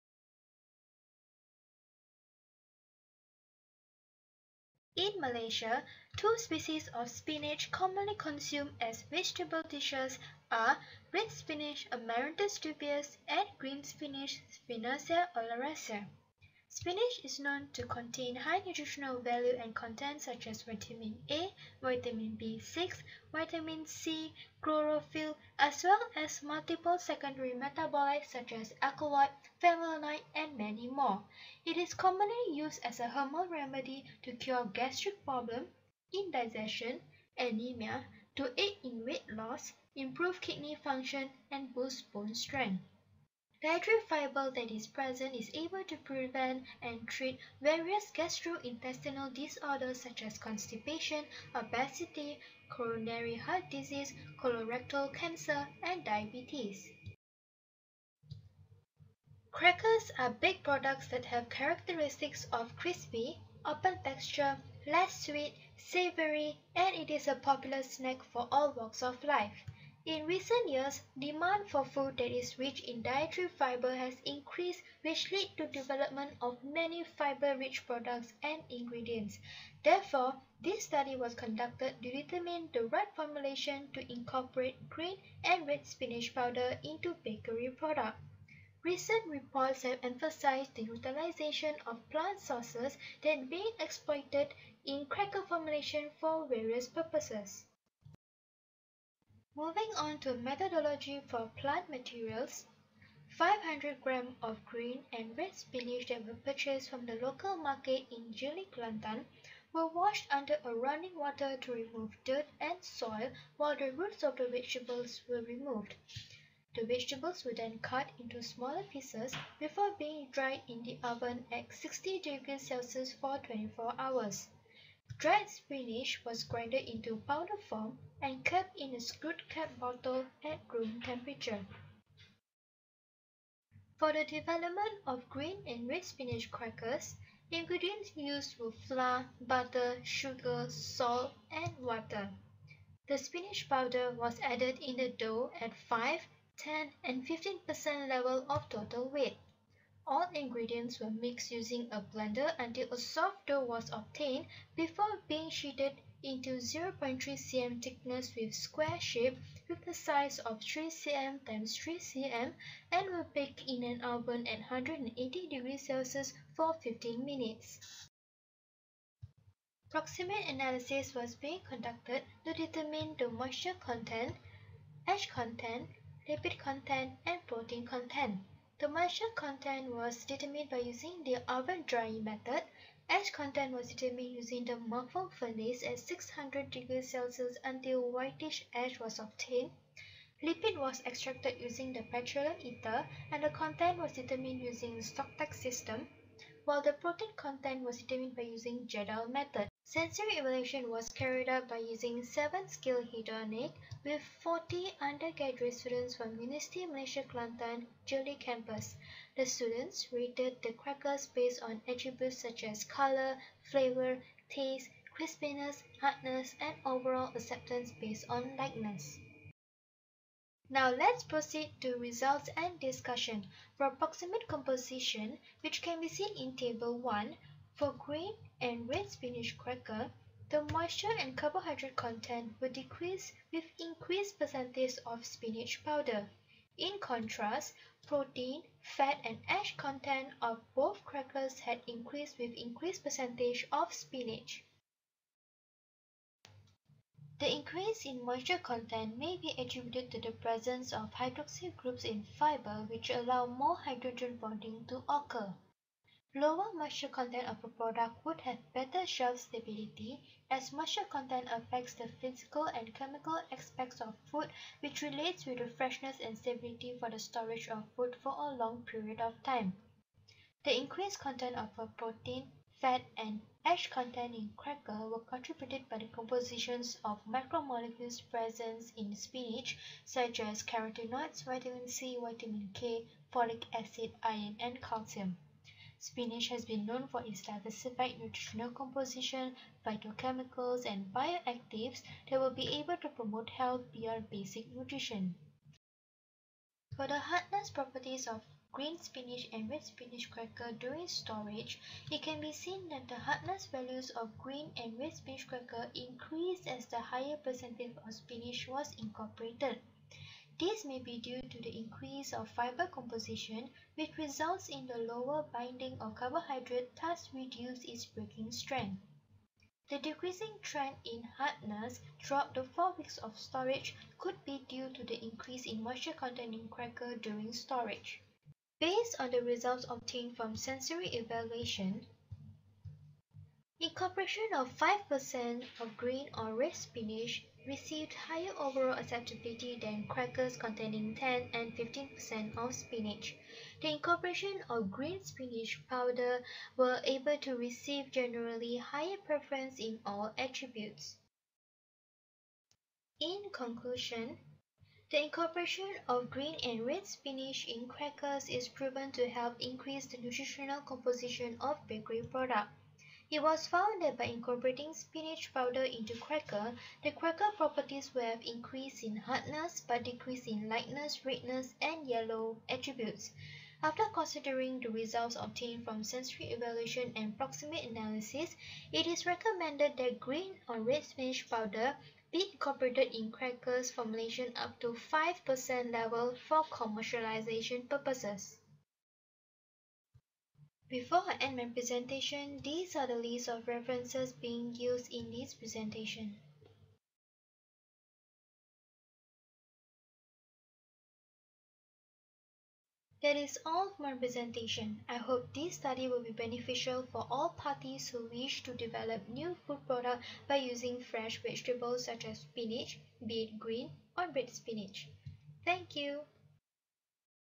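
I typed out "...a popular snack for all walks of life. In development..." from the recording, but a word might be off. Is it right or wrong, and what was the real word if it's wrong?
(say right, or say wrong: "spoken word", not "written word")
wrong: "recent", not "development".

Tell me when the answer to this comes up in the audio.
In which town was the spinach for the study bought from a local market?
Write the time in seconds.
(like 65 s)
108 s.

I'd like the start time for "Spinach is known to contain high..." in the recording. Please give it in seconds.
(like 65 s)
16 s.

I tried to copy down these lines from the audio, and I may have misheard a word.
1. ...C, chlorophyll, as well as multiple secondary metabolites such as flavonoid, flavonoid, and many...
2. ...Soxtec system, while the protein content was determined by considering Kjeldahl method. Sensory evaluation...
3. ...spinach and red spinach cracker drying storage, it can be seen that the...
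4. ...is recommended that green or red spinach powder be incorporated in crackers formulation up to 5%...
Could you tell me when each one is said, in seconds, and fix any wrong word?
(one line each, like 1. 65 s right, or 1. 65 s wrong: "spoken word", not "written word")
1. 23 s wrong: "alkaloid", not "flavonoid"
2. 195 s wrong: "using", not "considering"
3. 298 s wrong: "during", not "drying"
4. 379 s right.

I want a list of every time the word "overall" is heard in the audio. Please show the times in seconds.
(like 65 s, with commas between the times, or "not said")
216 s, 338 s.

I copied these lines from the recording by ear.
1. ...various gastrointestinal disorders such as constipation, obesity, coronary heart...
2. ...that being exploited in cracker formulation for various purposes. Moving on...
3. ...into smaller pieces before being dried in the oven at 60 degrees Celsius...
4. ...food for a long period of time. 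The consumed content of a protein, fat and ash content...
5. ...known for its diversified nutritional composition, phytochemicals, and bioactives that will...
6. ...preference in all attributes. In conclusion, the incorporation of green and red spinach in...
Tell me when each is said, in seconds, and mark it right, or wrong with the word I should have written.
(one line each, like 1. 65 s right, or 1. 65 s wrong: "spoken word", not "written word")
1. 47 s right
2. 93 s right
3. 118 s right
4. 267 s wrong: "increased", not "consumed"
5. 286 s right
6. 349 s right.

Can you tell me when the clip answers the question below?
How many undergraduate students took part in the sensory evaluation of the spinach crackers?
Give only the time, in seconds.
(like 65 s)
204 s.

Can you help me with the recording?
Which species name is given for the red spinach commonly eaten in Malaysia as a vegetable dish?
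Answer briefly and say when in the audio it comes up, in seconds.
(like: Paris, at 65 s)
Amaranthus dubius, at 11 s.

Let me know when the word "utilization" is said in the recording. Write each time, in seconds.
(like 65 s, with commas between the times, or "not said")
90 s.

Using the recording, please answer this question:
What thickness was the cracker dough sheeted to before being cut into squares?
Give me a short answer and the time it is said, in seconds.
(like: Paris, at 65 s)
0.3 cm, at 156 s.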